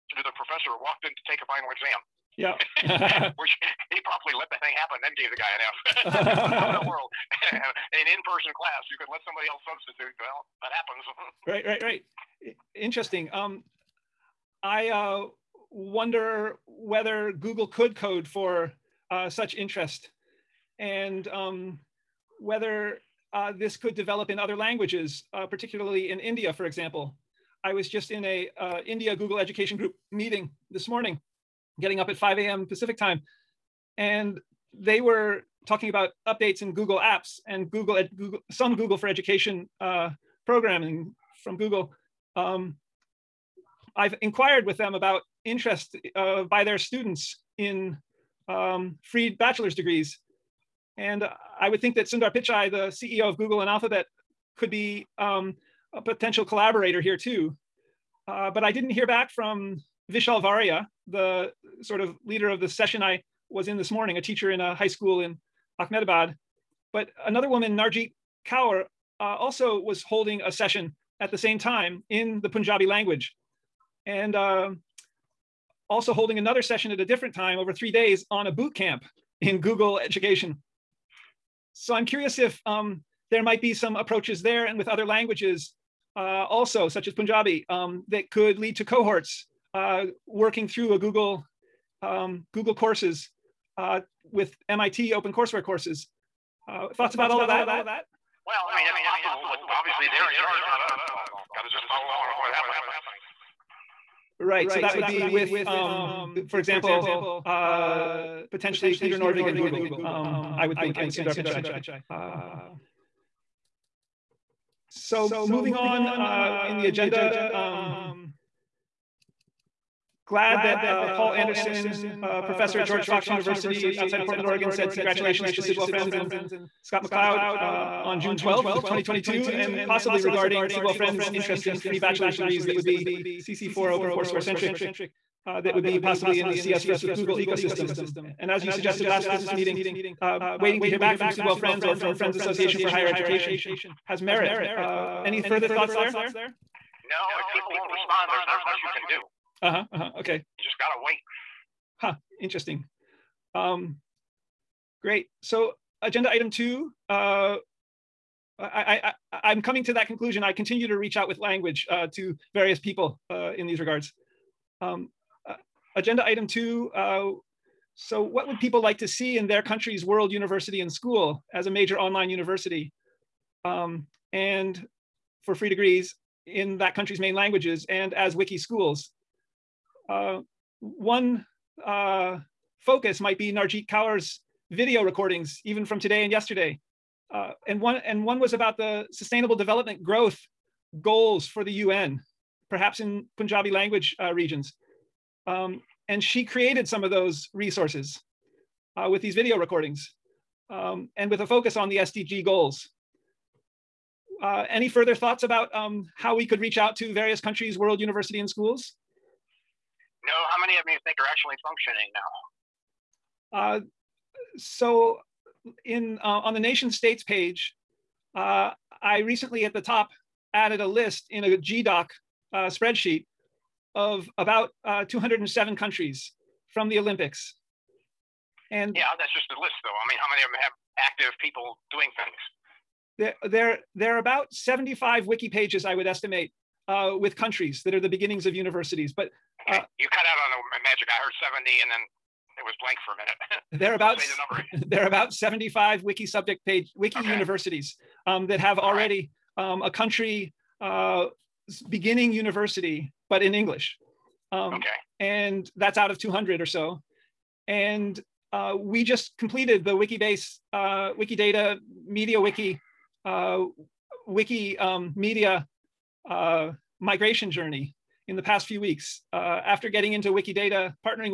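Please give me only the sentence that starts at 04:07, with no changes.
universities um, that have already right.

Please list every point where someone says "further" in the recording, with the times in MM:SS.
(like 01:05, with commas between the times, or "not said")
02:25, 03:24.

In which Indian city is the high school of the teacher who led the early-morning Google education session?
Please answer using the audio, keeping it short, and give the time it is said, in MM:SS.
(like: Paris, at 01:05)
Ahmedabad, at 01:05.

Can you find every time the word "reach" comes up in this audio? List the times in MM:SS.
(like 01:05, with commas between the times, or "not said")
02:40, 03:26.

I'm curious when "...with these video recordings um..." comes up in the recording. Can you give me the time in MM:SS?
03:19.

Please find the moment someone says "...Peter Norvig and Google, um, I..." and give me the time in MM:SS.
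01:48.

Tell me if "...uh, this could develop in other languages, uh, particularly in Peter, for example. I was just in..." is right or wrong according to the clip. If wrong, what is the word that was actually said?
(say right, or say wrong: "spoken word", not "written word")
wrong: "India", not "Peter".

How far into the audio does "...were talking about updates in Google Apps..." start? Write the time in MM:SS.
00:35.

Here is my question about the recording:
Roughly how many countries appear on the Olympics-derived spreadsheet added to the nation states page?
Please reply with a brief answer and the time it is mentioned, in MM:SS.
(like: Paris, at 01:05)
207, at 03:45.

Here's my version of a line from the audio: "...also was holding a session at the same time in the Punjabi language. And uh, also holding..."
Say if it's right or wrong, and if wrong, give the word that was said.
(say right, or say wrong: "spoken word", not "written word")
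right.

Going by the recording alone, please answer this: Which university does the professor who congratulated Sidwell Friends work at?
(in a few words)
George Fox University.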